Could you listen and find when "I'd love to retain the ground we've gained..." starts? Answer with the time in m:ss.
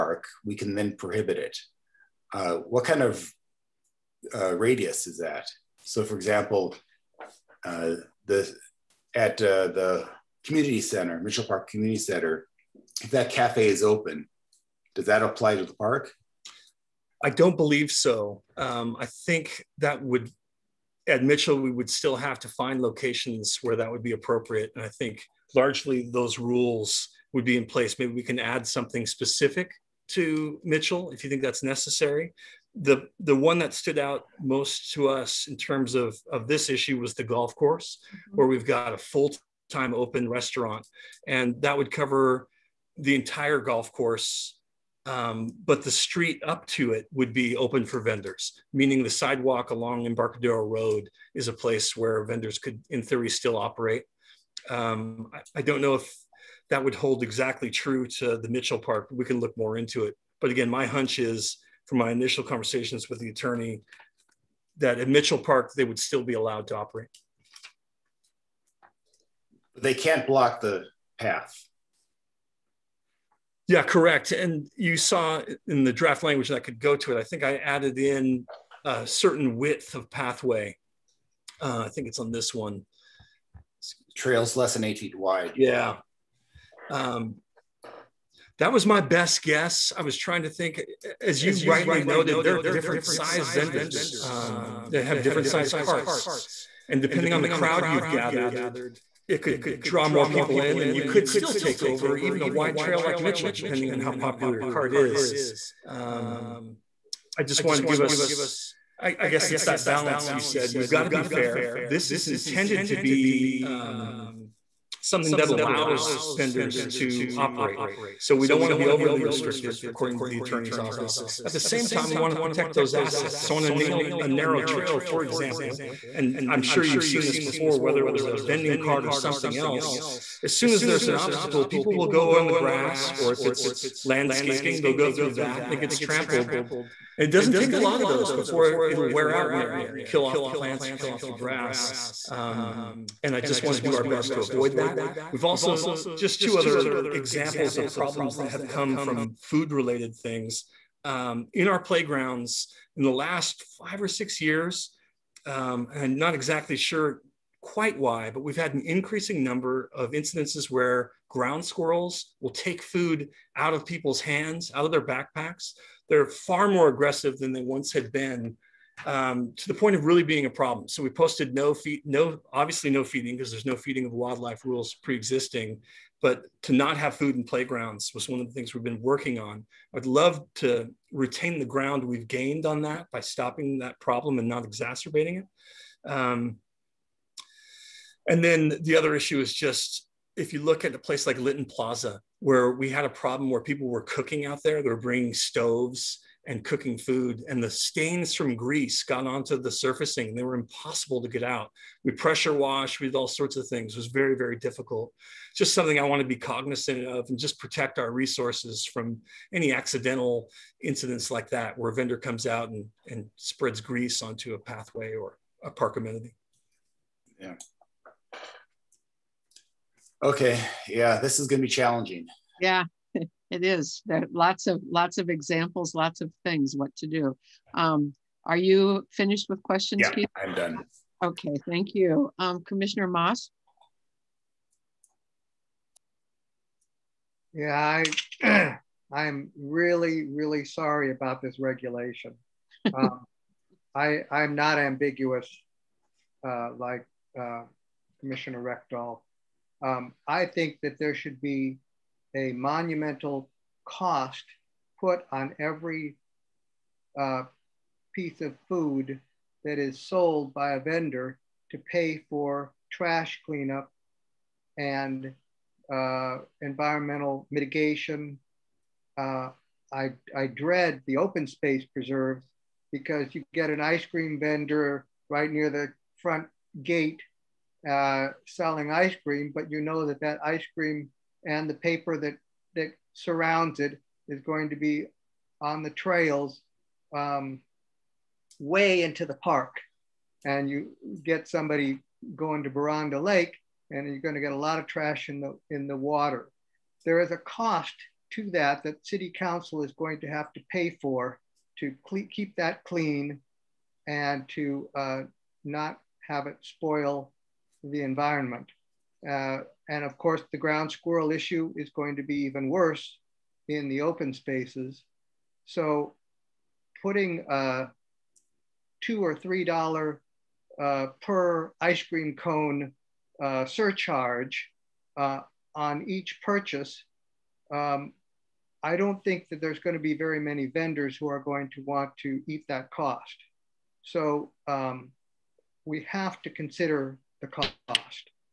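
2:59.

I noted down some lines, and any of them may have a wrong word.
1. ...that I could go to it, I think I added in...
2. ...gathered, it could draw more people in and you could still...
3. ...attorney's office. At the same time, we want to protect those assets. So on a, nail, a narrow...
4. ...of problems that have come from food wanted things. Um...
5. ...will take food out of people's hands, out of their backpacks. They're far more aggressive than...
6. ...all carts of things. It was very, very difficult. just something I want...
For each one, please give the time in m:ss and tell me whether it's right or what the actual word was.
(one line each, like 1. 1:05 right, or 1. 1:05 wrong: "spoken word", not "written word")
1. 1:16 right
2. 1:38 right
3. 2:00 right
4. 2:27 wrong: "related", not "wanted"
5. 2:42 right
6. 3:23 wrong: "sorts", not "carts".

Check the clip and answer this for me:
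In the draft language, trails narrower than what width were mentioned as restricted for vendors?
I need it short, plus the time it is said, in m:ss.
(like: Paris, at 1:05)
8 feet, at 1:24.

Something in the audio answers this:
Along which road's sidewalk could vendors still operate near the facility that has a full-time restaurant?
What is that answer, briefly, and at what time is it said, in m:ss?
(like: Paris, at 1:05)
Embarcadero Road, at 0:50.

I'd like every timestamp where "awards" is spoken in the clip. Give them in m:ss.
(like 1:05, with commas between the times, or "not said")
not said.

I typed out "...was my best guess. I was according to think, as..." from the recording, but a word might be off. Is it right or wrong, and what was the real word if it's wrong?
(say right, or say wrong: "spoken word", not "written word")
wrong: "trying", not "according".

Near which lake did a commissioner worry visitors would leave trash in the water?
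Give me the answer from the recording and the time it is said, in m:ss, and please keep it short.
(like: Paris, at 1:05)
Boronda Lake, at 4:52.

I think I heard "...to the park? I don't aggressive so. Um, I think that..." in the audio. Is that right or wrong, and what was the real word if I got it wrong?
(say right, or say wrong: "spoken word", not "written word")
wrong: "believe", not "aggressive".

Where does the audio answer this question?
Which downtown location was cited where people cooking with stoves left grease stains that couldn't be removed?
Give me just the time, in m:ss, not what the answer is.
3:11.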